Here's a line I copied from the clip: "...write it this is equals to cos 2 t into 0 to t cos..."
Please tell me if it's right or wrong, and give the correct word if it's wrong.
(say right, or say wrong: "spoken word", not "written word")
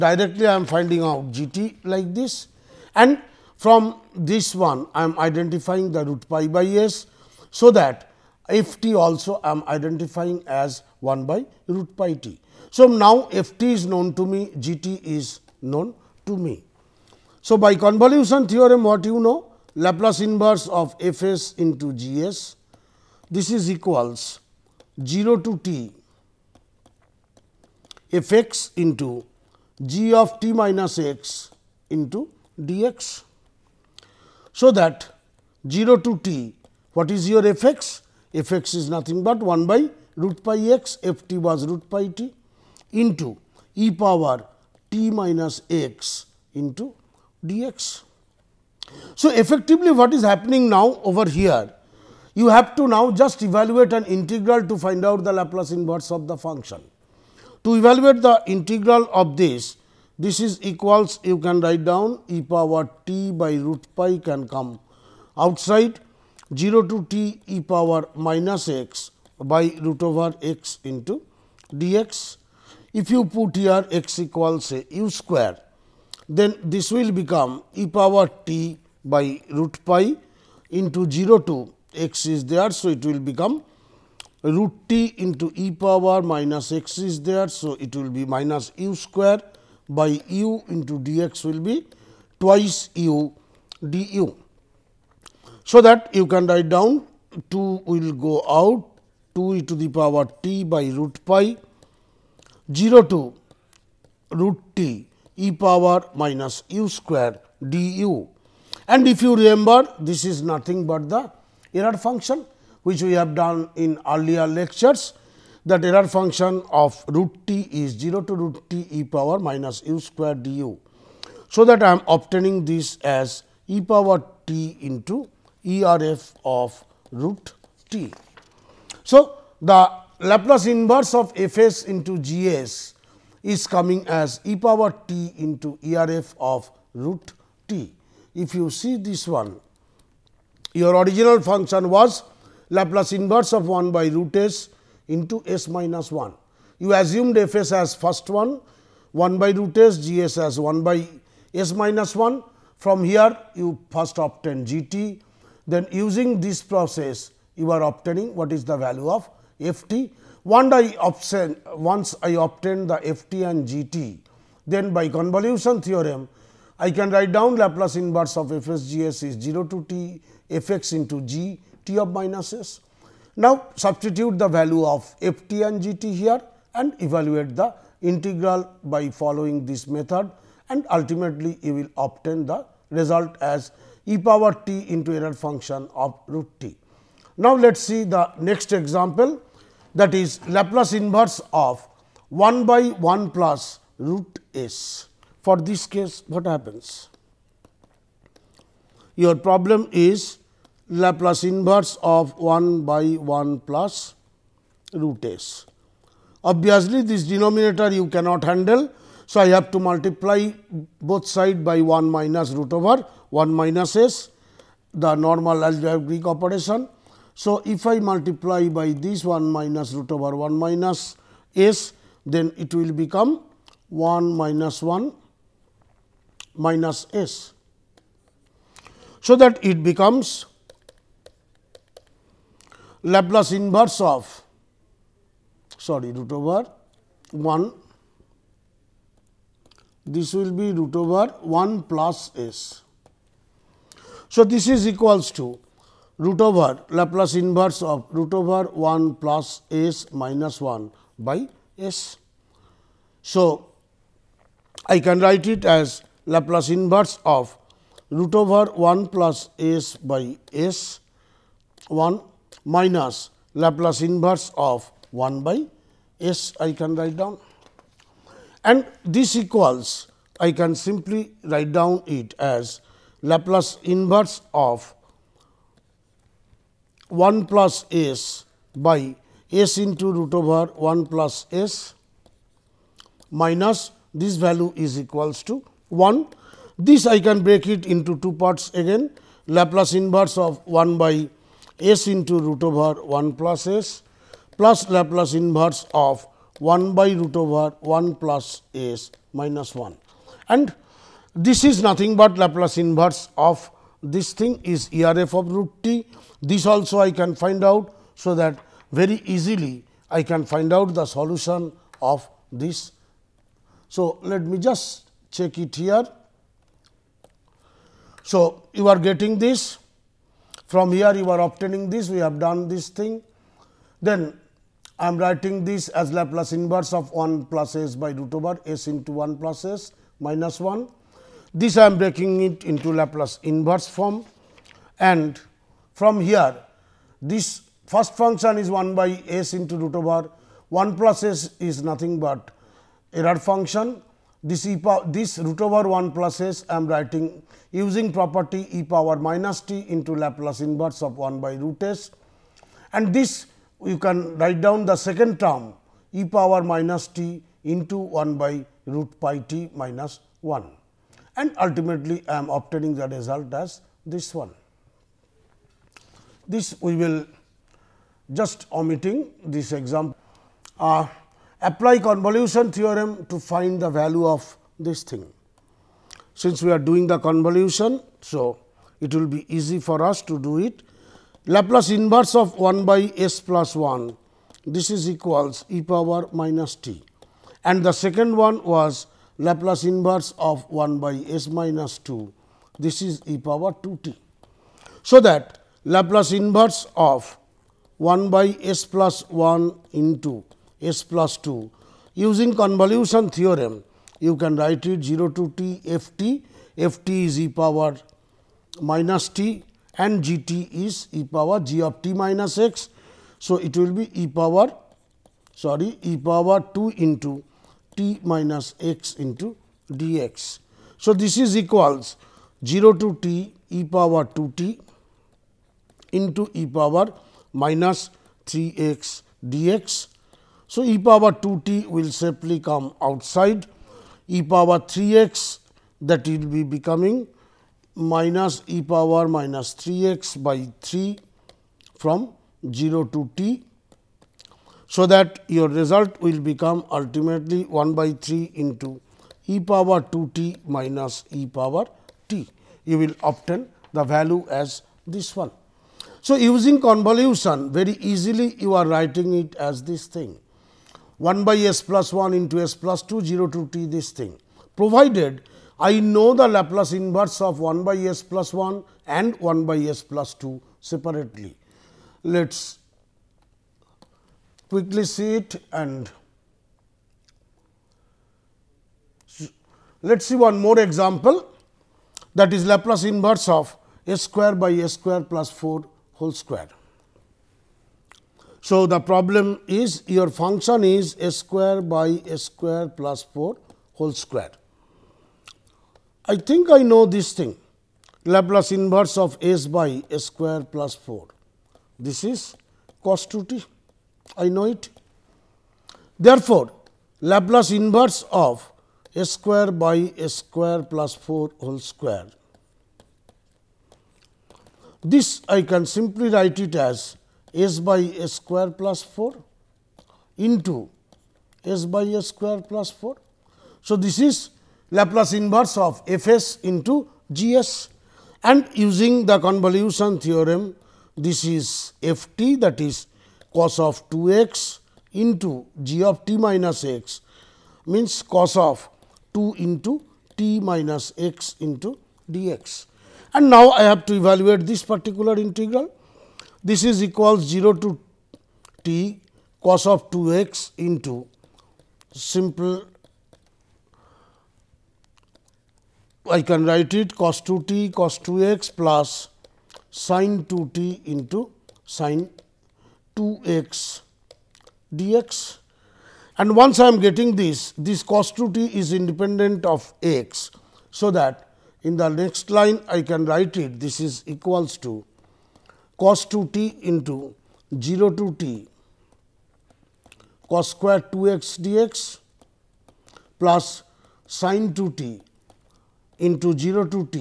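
right.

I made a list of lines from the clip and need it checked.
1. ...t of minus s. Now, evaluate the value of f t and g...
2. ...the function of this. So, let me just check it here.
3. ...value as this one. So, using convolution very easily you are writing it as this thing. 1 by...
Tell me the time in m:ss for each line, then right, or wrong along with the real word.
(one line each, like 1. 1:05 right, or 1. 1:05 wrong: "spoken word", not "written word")
1. 2:51 wrong: "substitute", not "evaluate"
2. 5:10 wrong: "solution", not "function"
3. 7:34 right.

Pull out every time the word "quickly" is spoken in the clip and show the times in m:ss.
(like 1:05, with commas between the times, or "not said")
7:54.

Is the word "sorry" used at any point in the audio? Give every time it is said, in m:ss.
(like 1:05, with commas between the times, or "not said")
3:55, 6:55.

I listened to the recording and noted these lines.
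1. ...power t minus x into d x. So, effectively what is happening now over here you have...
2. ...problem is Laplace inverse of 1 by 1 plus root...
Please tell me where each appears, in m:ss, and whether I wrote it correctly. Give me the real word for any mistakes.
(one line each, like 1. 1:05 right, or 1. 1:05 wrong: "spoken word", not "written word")
1. 0:43 right
2. 3:19 right.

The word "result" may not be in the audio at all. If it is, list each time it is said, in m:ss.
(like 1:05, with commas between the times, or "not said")
3:02, 6:03, 7:25.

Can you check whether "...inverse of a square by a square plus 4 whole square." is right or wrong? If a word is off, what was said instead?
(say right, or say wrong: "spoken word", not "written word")
right.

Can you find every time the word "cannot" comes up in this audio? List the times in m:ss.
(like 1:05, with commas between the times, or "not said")
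3:28.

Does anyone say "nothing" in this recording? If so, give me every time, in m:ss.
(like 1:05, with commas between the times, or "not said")
0:38, 1:50, 5:01, 5:41.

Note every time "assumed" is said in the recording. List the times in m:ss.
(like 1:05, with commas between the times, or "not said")
2:26.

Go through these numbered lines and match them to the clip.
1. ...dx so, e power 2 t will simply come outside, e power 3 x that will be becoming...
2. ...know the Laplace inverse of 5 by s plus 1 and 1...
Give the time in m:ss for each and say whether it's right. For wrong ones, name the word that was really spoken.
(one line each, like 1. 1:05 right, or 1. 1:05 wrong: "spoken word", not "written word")
1. 7:09 right
2. 7:45 wrong: "1", not "5".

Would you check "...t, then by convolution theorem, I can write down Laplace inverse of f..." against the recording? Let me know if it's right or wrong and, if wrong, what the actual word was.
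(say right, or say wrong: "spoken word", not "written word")
right.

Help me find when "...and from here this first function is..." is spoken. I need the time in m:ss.
5:34.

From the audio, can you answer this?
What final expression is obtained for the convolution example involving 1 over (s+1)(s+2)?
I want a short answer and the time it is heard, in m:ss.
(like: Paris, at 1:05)
1/3 (e^(2t) - e^t), at 7:27.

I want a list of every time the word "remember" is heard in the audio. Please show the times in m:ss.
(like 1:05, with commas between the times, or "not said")
1:49.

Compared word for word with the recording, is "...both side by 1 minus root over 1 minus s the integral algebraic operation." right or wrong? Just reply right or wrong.
wrong.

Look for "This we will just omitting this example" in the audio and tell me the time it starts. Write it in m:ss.
6:06.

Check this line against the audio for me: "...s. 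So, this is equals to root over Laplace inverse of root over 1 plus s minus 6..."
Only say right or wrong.
wrong.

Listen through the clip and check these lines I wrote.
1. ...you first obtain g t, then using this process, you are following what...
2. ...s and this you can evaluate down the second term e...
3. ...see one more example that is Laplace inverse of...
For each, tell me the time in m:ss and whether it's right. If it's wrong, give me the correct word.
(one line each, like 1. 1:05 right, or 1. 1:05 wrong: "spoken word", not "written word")
1. 2:33 wrong: "obtaining", not "following"
2. 5:51 wrong: "write", not "evaluate"
3. 8:00 right.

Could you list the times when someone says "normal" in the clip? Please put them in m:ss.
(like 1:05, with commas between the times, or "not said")
3:35.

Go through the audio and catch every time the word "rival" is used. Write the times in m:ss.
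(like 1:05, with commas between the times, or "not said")
not said.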